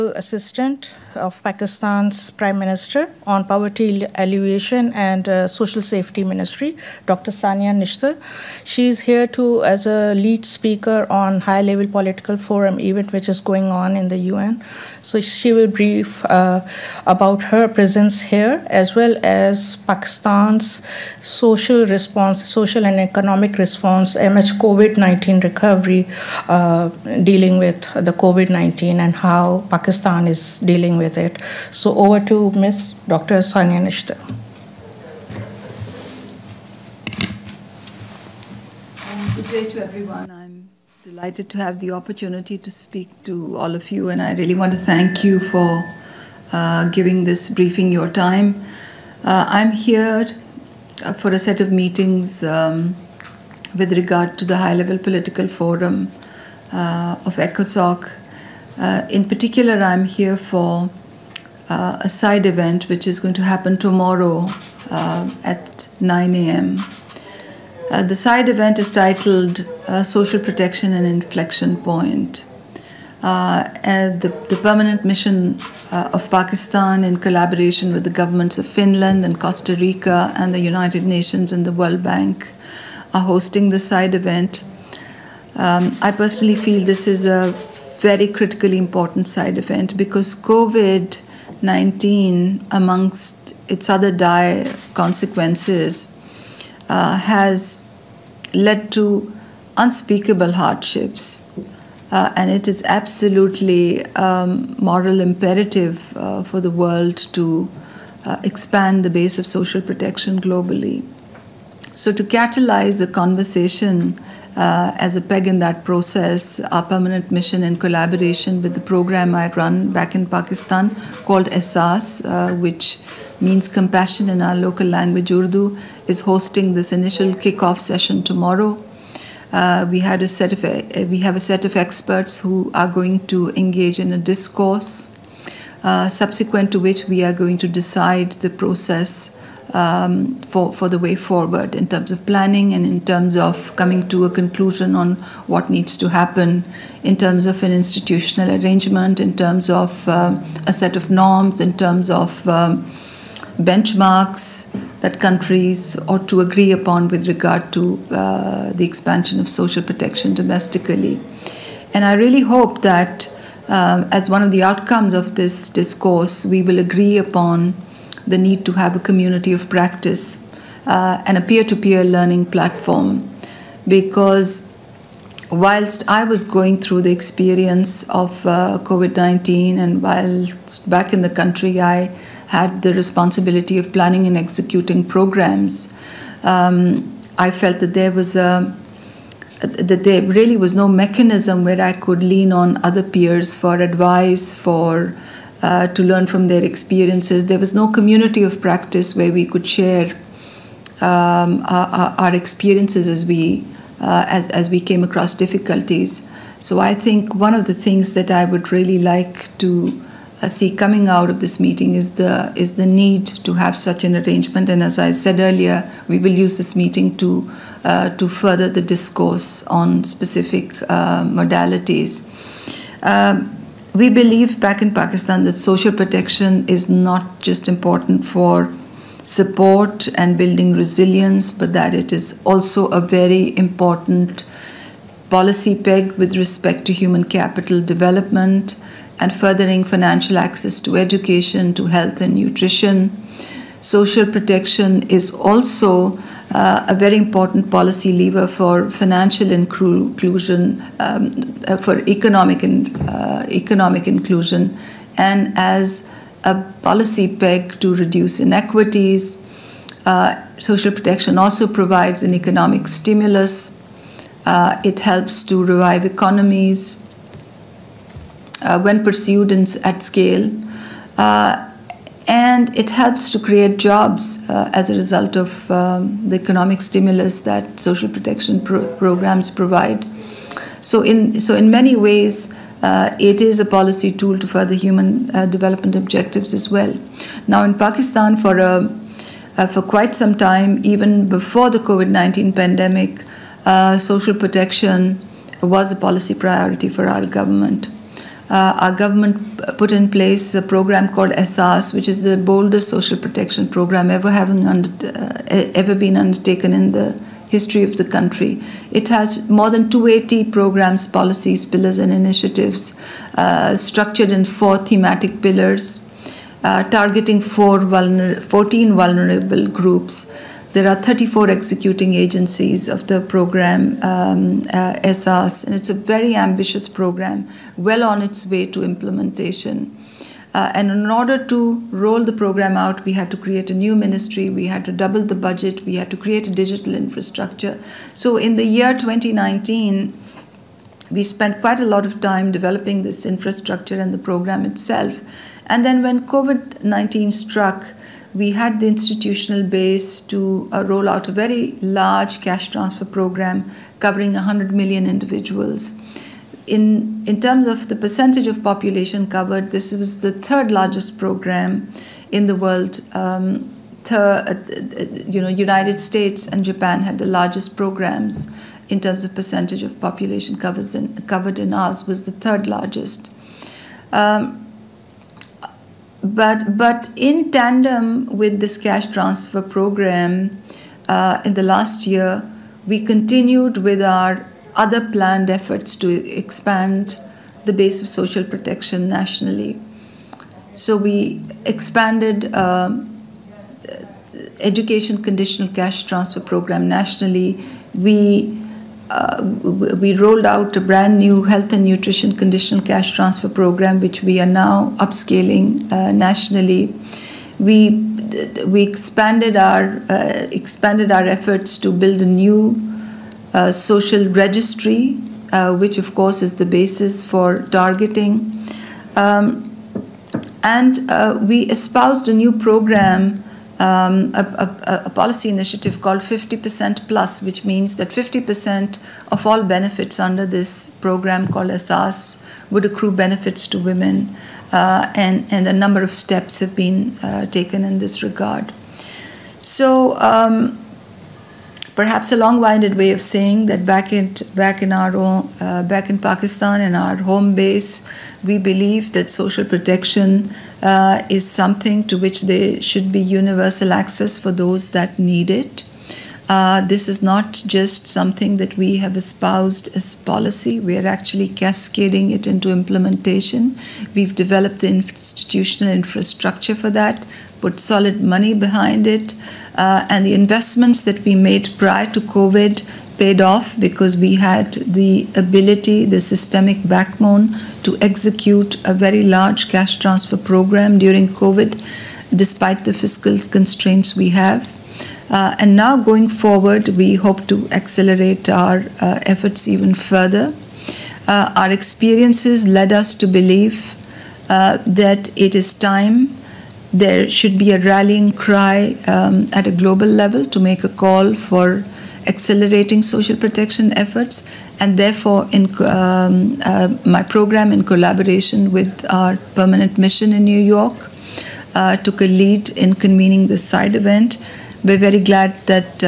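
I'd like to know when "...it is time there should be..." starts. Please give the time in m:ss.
8:15.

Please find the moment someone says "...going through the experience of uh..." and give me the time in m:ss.
2:56.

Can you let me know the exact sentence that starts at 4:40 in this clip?
So in so in many ways, uh, it is a policy tool to further human uh, development objectives as well.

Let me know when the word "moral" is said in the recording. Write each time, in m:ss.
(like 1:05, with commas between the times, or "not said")
1:44.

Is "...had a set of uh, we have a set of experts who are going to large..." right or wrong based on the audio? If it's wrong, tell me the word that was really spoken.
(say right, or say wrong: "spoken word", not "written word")
wrong: "engage", not "large".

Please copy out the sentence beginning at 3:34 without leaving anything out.
And as I said earlier, we will use this meeting to uh, to further the discourse on specific uh, modalities.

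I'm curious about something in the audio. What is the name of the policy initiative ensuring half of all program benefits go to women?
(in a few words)
50% Plus.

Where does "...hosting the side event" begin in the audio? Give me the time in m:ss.
1:23.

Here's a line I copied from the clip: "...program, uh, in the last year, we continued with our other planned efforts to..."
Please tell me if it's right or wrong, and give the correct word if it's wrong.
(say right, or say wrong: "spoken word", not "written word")
right.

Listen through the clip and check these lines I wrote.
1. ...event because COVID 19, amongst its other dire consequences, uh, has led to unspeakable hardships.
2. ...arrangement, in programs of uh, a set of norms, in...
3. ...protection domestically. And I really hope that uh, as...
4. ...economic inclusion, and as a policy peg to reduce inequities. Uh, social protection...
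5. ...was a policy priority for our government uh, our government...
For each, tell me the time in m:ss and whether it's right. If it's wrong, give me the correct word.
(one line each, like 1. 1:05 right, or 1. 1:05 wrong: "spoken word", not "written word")
1. 1:29 right
2. 2:28 wrong: "terms", not "programs"
3. 2:39 right
4. 4:13 right
5. 4:55 right.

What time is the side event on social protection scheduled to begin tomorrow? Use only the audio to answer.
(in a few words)
9 a.m.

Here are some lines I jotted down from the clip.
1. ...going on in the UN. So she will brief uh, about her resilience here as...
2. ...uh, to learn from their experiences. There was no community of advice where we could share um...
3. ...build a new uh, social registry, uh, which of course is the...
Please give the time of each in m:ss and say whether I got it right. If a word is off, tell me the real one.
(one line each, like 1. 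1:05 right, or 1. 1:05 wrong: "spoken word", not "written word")
1. 0:13 wrong: "presence", not "resilience"
2. 3:15 wrong: "practice", not "advice"
3. 6:51 right.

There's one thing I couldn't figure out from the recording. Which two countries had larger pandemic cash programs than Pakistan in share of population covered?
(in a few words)
United States and Japan.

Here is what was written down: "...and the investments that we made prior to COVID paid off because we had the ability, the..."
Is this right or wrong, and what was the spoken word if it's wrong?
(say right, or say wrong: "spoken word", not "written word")
right.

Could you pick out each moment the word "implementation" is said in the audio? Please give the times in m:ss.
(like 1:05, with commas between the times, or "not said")
5:28, 7:42.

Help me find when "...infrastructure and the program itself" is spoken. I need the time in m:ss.
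5:43.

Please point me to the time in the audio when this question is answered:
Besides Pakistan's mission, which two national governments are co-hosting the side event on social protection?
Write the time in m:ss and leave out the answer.
1:18.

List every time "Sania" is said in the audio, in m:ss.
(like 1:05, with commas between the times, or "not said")
0:07, 0:33.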